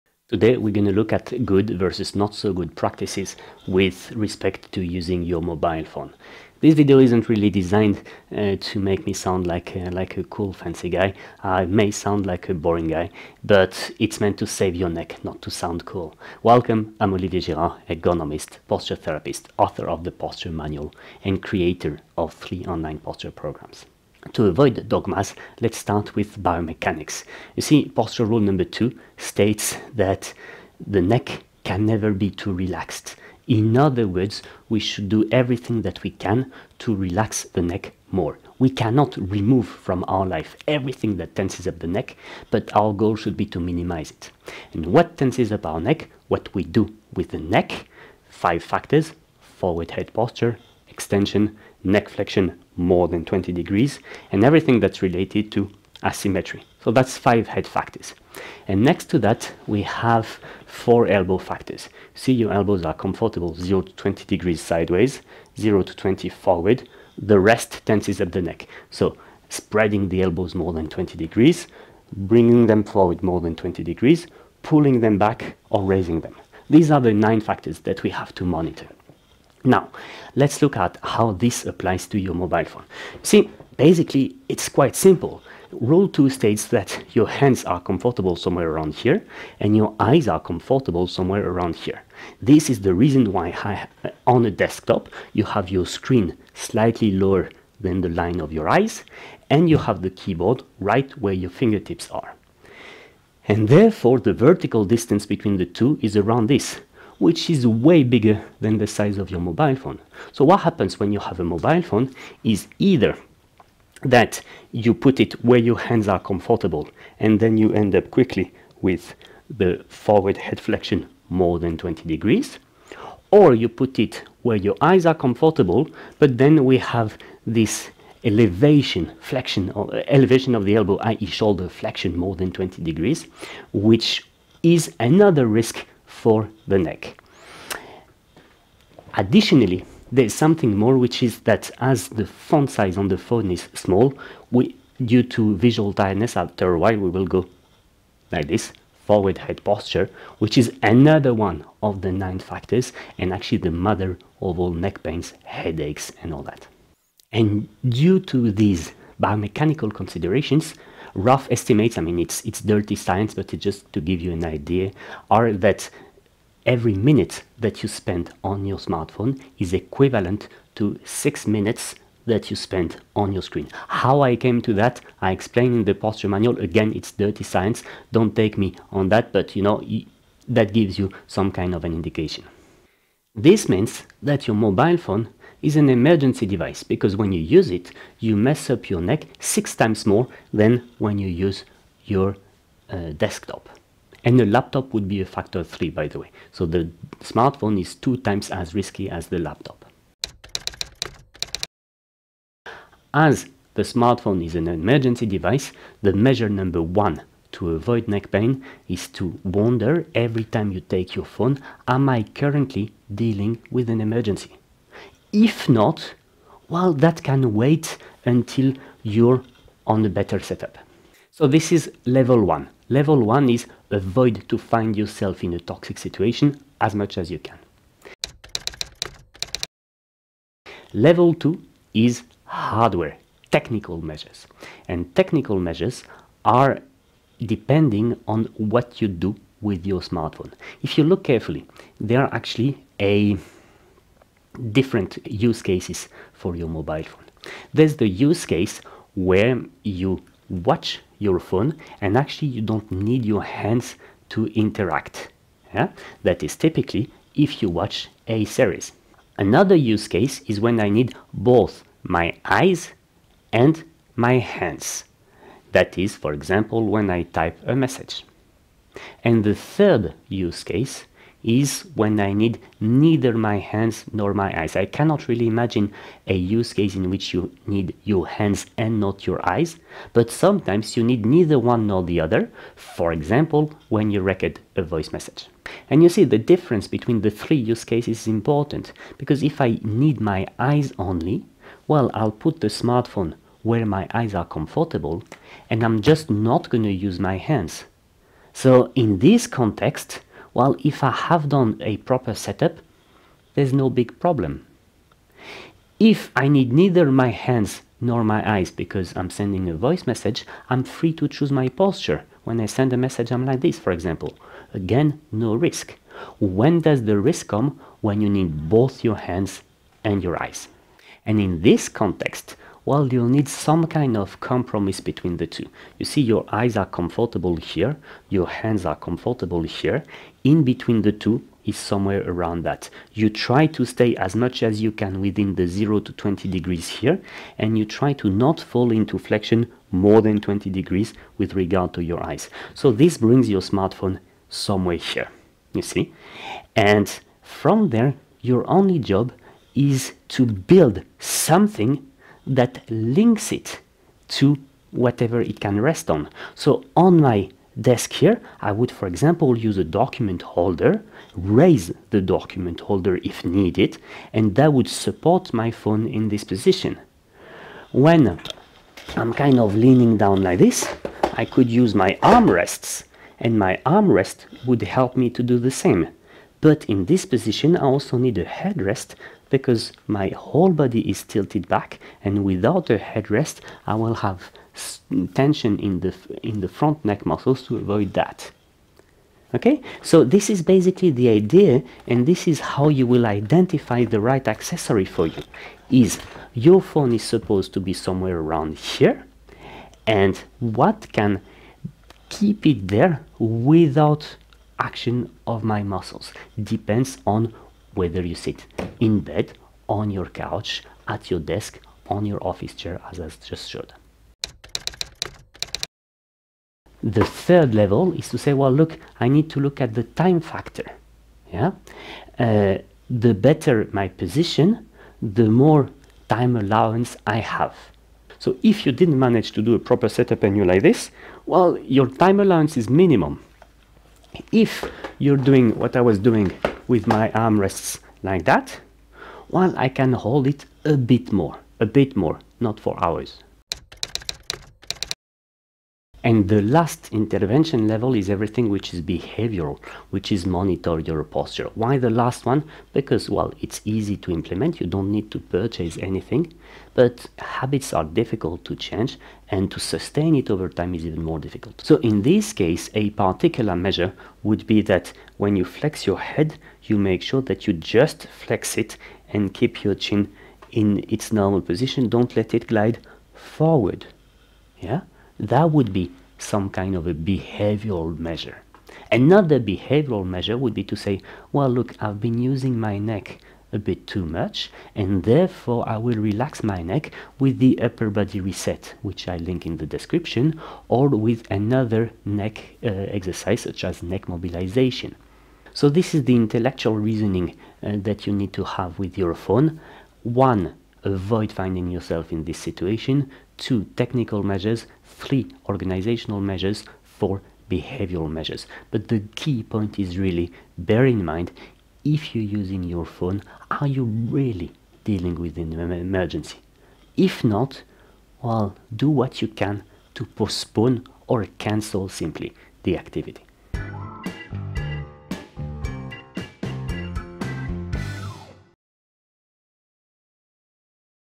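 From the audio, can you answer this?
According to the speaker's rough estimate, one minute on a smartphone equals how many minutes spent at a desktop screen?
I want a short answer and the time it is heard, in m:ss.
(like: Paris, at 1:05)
6, at 2:51.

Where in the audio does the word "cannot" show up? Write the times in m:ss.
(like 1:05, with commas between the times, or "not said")
0:38, 4:34.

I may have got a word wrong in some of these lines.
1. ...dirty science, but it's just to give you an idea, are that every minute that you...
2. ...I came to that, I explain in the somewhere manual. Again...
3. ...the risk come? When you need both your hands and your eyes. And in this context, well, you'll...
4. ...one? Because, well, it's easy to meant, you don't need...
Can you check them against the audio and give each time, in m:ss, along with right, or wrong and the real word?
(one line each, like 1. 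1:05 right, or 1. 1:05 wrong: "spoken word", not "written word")
1. 2:42 right
2. 2:54 wrong: "posture", not "somewhere"
3. 5:17 right
4. 7:32 wrong: "implement", not "meant".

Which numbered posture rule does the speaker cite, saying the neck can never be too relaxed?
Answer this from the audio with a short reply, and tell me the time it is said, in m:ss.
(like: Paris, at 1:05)
2, at 0:28.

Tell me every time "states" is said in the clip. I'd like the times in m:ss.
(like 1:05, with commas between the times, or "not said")
0:29, 1:26.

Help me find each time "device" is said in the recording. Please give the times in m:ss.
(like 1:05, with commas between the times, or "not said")
3:06, 3:25.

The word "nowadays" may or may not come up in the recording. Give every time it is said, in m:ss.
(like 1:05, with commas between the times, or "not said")
not said.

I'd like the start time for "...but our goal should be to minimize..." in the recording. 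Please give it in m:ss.
0:42.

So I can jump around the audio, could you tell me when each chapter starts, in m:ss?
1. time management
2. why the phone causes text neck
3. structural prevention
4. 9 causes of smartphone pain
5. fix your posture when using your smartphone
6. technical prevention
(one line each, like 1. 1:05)
1. 6:55
2. 1:20
3. 3:21
4. 0:24
5. 7:24
6. 3:49.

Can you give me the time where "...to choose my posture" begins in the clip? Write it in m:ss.
5:11.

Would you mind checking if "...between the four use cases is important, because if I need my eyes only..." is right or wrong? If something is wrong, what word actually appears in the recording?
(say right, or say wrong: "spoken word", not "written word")
wrong: "three", not "four".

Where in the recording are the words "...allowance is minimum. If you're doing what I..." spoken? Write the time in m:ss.
7:12.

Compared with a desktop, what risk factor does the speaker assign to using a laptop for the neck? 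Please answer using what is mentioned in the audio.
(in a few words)
3.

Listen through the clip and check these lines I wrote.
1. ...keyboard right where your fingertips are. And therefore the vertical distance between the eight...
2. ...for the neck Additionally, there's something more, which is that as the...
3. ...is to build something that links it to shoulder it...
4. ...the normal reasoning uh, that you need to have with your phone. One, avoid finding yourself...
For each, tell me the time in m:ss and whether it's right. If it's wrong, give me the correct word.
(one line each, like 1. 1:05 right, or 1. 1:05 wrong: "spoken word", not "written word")
1. 1:40 wrong: "two", not "eight"
2. 2:16 right
3. 5:49 wrong: "whatever", not "shoulder"
4. 8:16 wrong: "intellectual", not "normal".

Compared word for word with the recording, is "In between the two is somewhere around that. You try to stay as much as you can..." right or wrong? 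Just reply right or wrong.
right.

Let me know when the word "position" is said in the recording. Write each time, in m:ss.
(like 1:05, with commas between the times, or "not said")
6:06, 6:17, 7:04, 7:51.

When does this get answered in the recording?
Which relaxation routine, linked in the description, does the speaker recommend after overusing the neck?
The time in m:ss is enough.
8:07.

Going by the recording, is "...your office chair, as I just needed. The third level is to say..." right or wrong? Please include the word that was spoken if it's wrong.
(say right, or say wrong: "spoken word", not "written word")
wrong: "showed", not "needed".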